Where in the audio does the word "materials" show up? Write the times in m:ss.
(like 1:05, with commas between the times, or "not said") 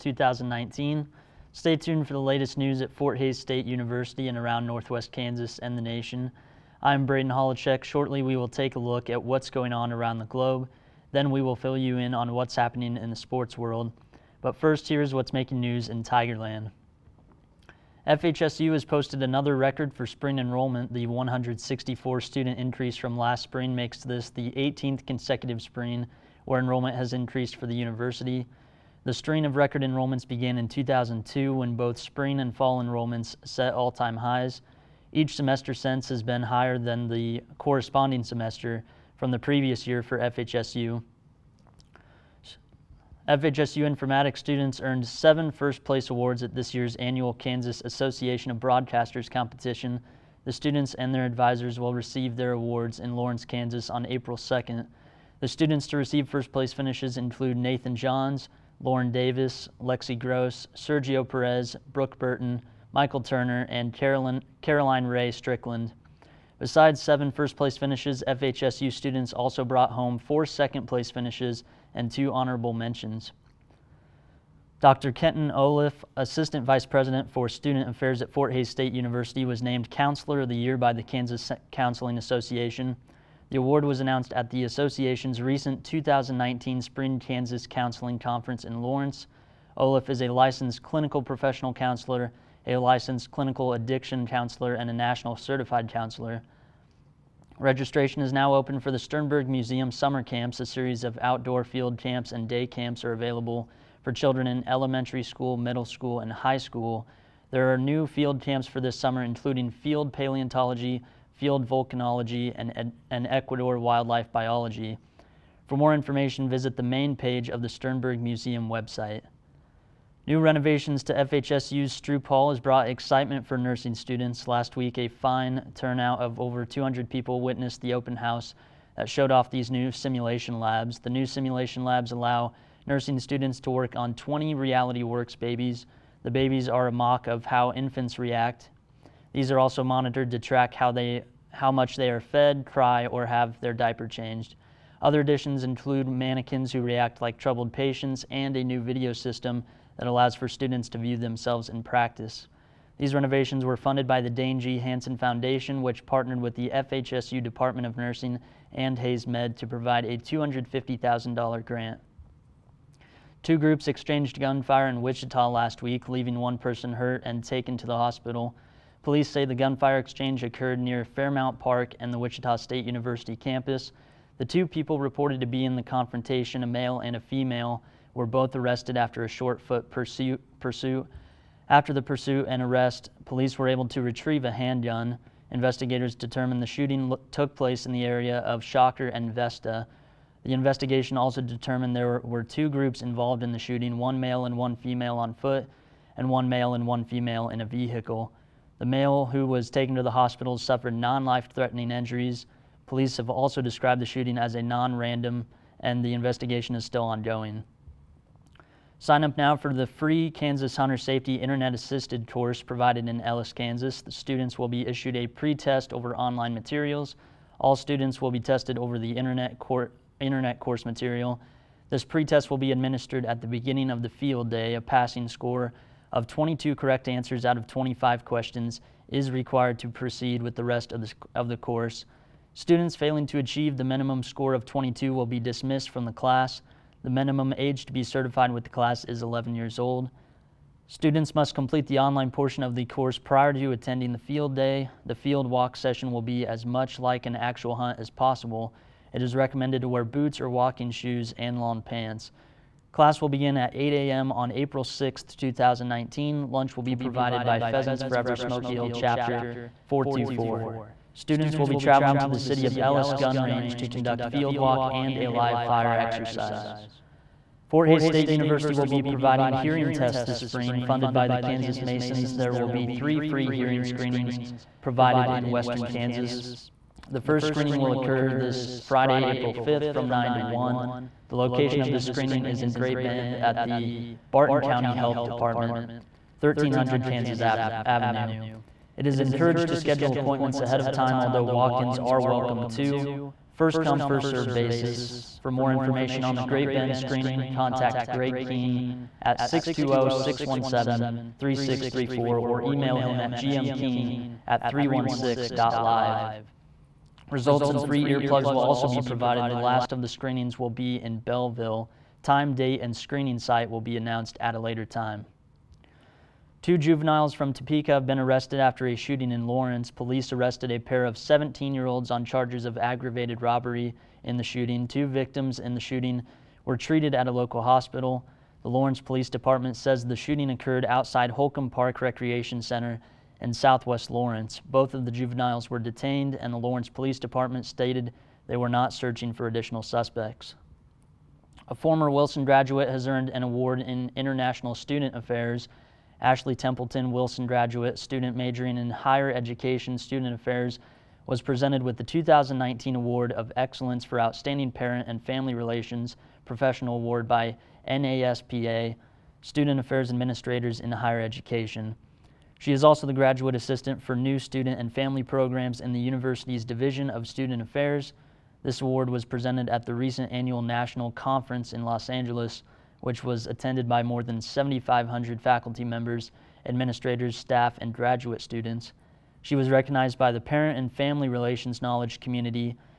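3:36, 3:40.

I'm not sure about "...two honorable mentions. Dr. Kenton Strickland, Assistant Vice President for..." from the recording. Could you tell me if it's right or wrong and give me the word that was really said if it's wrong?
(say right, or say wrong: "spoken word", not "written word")
wrong: "Olliff", not "Strickland".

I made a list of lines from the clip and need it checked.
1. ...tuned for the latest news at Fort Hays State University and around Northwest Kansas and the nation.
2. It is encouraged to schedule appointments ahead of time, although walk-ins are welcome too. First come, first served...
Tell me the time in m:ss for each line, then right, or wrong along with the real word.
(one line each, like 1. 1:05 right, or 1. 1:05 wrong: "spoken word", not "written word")
1. 0:01 right
2. 4:48 right.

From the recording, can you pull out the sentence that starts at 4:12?
Class will begin at 8 a.m.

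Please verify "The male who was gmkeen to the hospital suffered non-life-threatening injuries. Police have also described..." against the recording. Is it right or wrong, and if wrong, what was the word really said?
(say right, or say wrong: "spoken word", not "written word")
wrong: "taken", not "gmkeen".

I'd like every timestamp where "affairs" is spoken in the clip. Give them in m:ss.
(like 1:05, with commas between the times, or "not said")
1:17, 5:45, 5:50, 5:59, 6:07.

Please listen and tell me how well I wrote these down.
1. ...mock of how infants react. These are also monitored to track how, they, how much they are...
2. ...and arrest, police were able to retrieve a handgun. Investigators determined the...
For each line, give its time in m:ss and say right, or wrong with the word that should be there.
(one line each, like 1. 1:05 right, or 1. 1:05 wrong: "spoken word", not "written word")
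1. 2:16 right
2. 3:02 right.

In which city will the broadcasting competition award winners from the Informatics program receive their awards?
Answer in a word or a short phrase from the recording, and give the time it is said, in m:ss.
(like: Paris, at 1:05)
Lawrence, Kansas, at 0:53.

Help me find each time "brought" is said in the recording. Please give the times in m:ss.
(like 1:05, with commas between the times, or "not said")
1:09, 2:02.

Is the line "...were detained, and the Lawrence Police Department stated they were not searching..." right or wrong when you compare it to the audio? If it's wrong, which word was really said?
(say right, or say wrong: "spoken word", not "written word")
right.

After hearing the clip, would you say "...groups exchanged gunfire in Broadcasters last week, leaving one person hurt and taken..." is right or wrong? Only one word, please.
wrong.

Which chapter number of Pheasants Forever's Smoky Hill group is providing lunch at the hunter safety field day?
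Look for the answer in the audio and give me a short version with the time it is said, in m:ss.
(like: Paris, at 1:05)
424, at 4:19.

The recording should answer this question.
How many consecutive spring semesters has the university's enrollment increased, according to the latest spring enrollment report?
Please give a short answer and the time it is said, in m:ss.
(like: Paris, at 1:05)
18, at 0:24.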